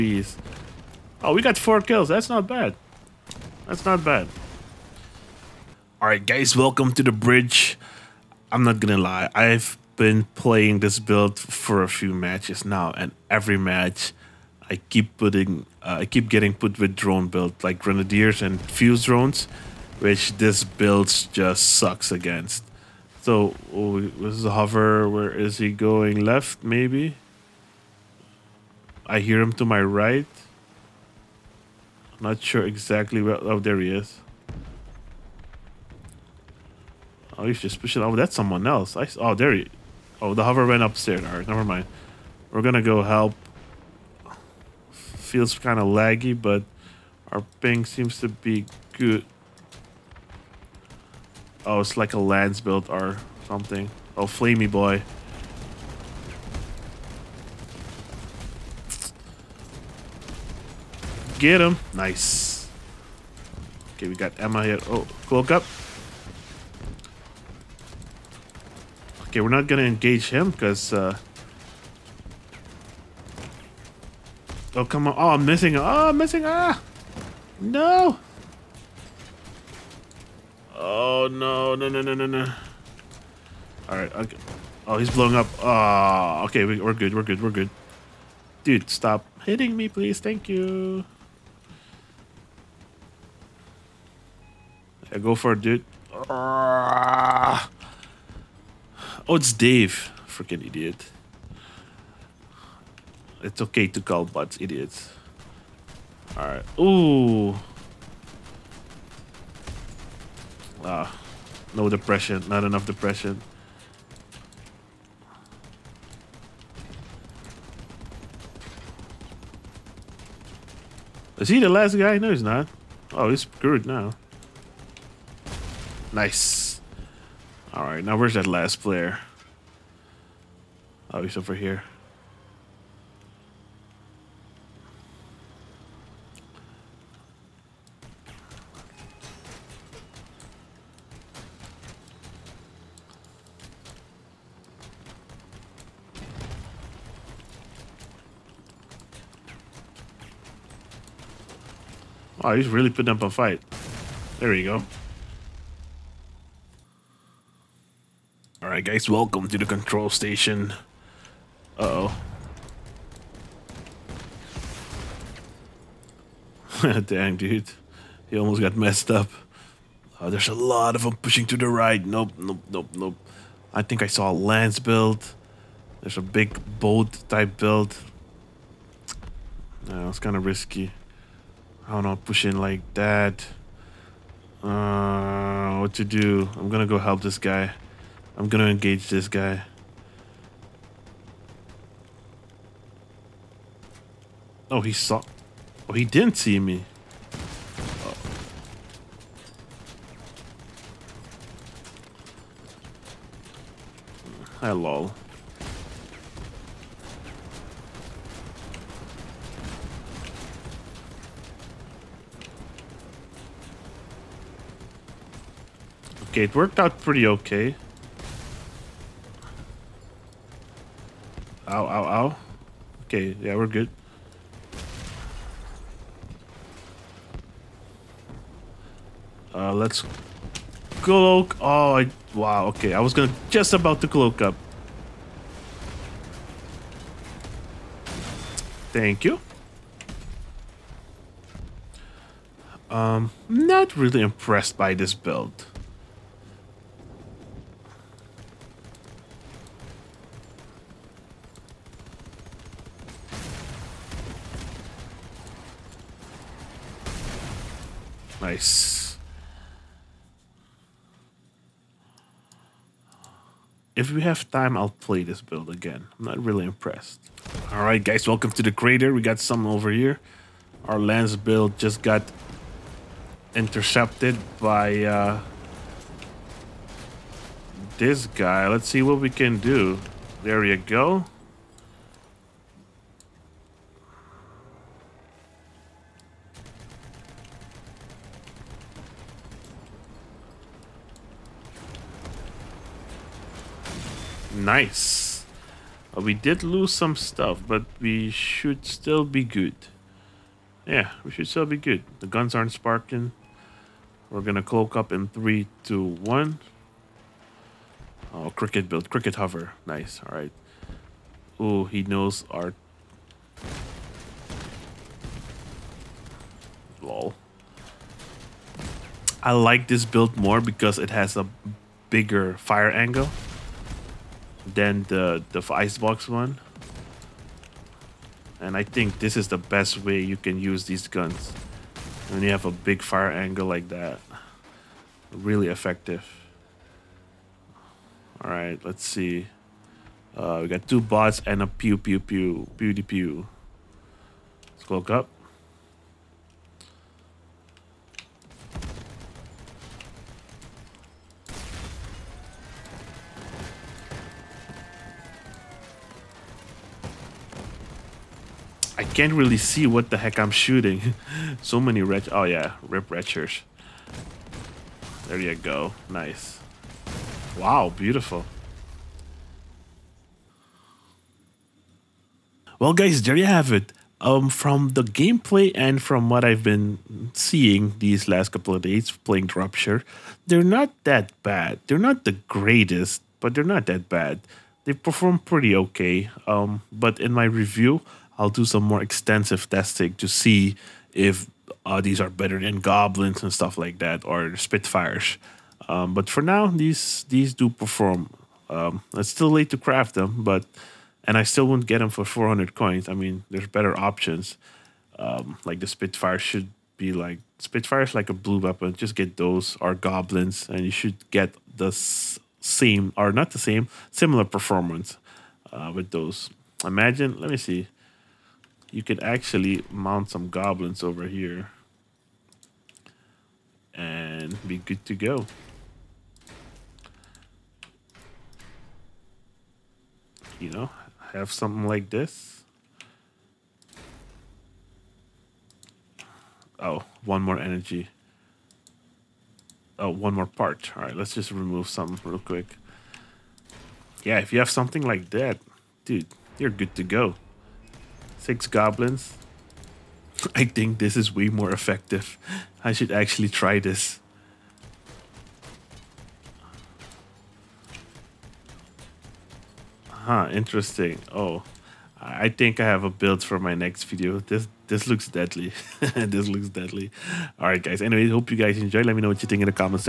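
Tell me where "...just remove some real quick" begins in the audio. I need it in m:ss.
7:21.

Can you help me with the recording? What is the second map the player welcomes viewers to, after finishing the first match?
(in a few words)
Control station.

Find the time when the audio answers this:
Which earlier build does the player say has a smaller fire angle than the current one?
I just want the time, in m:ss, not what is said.
5:25.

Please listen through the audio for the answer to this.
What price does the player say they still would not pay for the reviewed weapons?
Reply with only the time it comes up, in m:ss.
6:42.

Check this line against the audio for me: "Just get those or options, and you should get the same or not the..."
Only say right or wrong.
wrong.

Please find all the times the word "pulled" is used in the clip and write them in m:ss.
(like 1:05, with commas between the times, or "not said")
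not said.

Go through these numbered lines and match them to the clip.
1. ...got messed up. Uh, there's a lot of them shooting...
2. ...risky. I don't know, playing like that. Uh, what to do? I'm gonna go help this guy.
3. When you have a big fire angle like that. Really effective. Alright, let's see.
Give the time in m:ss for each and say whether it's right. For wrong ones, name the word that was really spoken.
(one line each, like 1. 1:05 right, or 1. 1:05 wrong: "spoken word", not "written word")
1. 2:48 wrong: "pushing", not "shooting"
2. 3:00 wrong: "pushing", not "playing"
3. 5:32 right.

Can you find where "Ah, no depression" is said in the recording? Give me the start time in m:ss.
1:50.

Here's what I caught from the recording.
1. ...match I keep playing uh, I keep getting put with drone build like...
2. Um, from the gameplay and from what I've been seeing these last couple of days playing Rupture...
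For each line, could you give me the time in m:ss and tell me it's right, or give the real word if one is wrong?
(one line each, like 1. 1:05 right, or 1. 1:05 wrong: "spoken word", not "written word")
1. 0:13 wrong: "putting", not "playing"
2. 6:14 right.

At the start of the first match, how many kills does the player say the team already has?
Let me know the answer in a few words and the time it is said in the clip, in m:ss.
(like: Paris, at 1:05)
4, at 0:01.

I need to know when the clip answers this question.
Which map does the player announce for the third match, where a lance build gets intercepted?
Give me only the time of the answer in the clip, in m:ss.
4:28.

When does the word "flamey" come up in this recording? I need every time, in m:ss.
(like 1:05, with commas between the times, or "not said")
0:54.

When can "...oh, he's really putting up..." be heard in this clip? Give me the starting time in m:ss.
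2:32.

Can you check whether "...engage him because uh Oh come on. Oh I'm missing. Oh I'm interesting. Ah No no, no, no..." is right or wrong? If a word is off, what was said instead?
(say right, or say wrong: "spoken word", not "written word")
wrong: "missing", not "interesting".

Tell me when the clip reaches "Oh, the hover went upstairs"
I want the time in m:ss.
0:40.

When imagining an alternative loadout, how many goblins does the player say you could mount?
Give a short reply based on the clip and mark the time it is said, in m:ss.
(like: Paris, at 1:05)
6, at 7:28.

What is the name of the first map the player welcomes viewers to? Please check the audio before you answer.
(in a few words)
The bridge.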